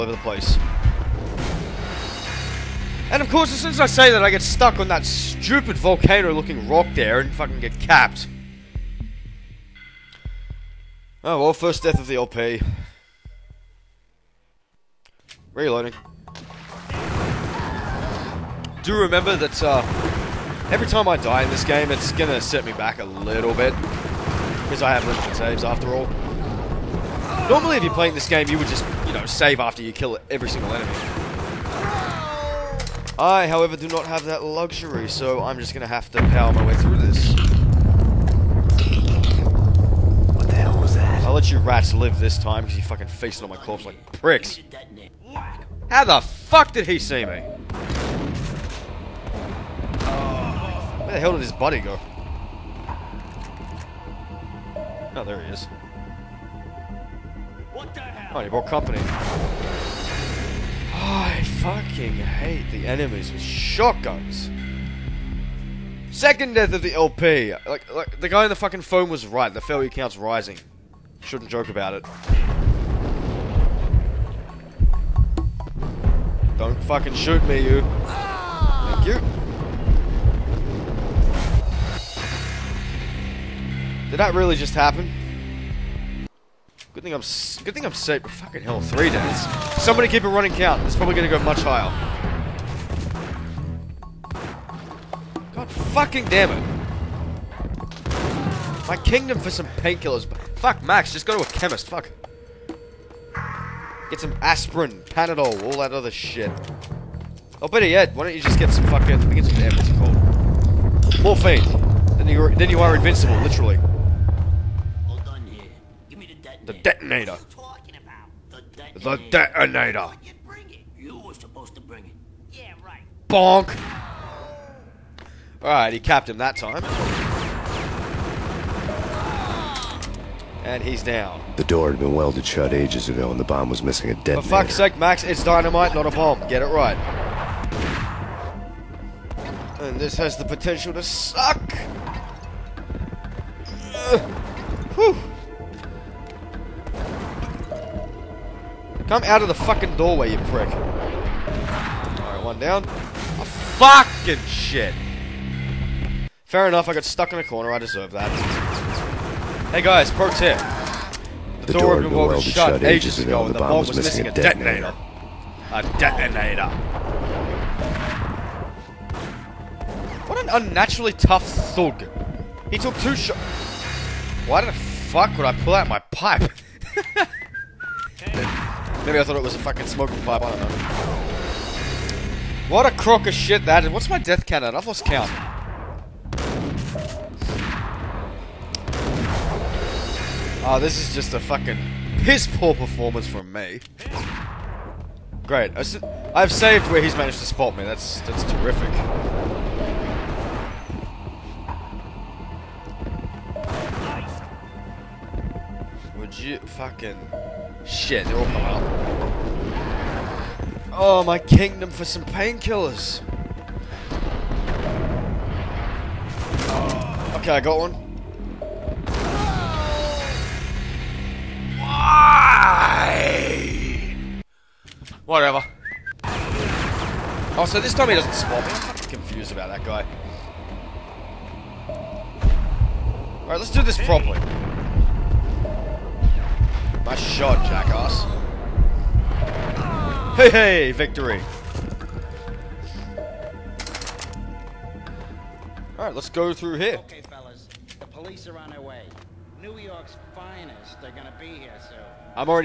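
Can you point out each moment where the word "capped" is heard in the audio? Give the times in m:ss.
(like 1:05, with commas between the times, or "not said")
0:07, 2:05.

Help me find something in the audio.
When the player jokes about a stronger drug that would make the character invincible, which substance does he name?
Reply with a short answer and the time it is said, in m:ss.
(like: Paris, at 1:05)
Morphine, at 1:51.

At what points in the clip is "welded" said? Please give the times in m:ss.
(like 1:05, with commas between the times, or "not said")
2:12.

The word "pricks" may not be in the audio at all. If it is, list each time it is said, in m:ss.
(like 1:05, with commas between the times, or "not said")
0:44, 2:30.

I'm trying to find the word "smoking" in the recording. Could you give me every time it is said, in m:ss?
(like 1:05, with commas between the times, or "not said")
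2:59.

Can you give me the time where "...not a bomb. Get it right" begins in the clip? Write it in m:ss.
2:15.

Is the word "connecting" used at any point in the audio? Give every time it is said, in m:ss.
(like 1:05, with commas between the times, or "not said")
not said.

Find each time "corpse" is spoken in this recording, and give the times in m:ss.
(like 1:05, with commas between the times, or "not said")
0:43.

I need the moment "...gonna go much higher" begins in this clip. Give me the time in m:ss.
1:31.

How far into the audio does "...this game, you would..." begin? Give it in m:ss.
0:28.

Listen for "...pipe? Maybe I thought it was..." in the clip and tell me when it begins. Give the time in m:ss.
2:56.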